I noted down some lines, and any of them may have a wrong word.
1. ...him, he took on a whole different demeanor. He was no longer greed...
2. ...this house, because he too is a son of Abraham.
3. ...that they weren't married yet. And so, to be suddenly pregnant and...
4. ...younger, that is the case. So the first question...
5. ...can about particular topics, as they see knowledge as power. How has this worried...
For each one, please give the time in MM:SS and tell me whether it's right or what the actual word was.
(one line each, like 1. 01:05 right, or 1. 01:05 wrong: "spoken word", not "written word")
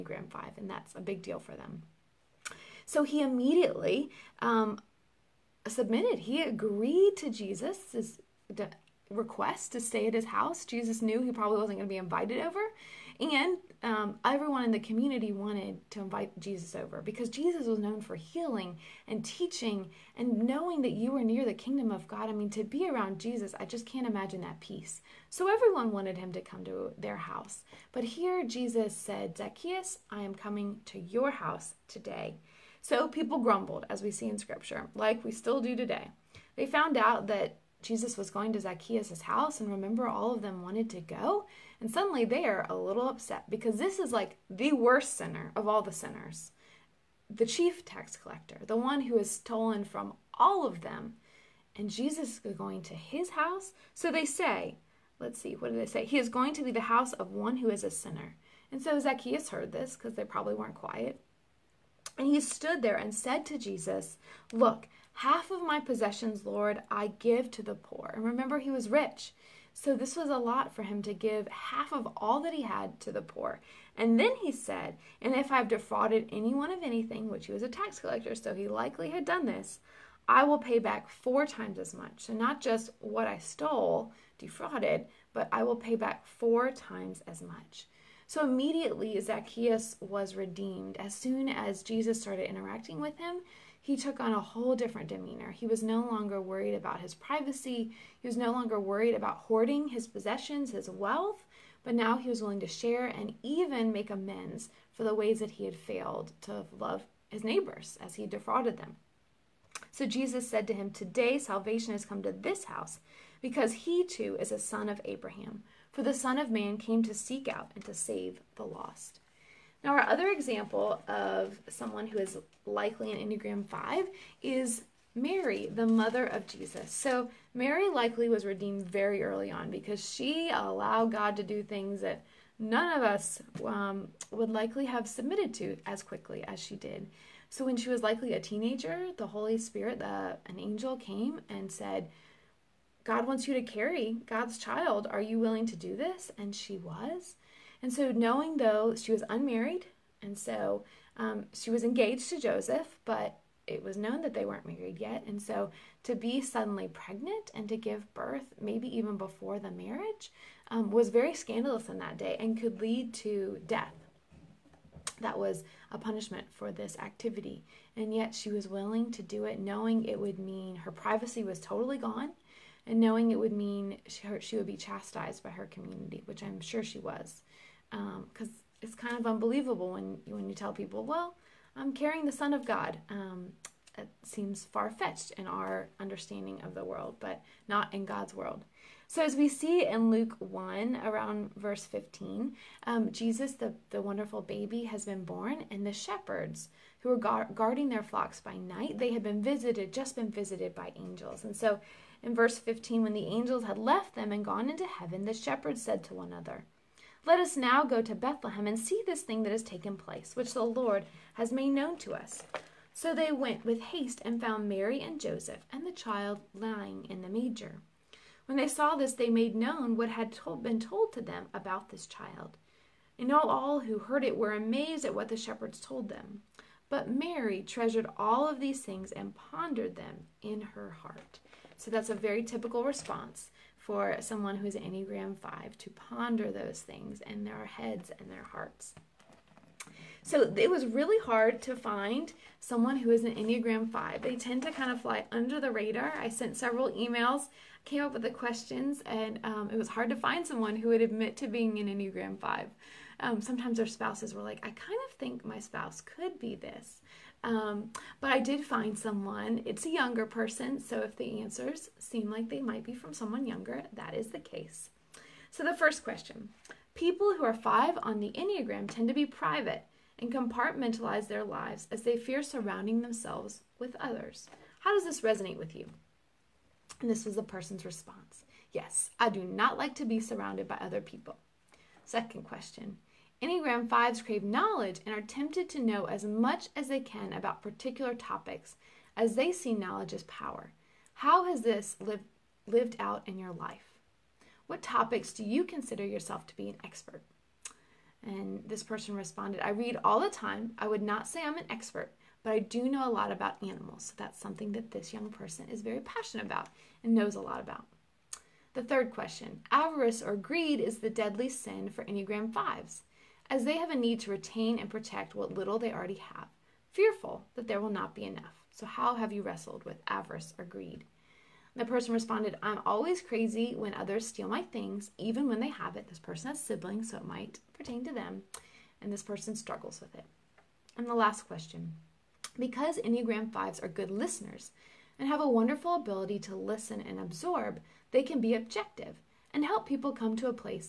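1. 01:33 wrong: "worried", not "greed"
2. 01:52 right
3. 02:34 right
4. 04:23 right
5. 04:47 wrong: "lived", not "worried".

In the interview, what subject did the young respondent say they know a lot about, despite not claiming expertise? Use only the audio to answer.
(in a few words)
Animals.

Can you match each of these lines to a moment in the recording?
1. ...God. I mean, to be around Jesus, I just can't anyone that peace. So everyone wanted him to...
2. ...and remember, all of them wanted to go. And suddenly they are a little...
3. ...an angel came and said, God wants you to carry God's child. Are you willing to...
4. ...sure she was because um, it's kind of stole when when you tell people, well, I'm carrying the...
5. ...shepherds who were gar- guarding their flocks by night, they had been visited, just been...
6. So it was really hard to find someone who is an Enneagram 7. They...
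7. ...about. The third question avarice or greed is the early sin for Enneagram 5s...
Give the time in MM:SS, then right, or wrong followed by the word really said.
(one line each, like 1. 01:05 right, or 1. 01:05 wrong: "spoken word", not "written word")
1. 00:22 wrong: "imagine", not "anyone"
2. 00:39 right
3. 02:20 right
4. 02:56 wrong: "unbelievable", not "stole"
5. 03:15 right
6. 04:00 wrong: "5", not "7"
7. 05:07 wrong: "deadly", not "early".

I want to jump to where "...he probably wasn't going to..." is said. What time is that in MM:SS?
00:11.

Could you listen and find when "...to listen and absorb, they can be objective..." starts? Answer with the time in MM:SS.
05:36.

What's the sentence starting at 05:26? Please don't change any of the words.
This person has siblings, so it might pertain to them, and this person struggles with it.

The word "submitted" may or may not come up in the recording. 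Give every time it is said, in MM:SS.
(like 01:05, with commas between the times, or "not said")
00:05, 02:15.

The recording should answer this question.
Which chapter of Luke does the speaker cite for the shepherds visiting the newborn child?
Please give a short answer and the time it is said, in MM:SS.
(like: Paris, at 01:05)
Luke 1, at 03:10.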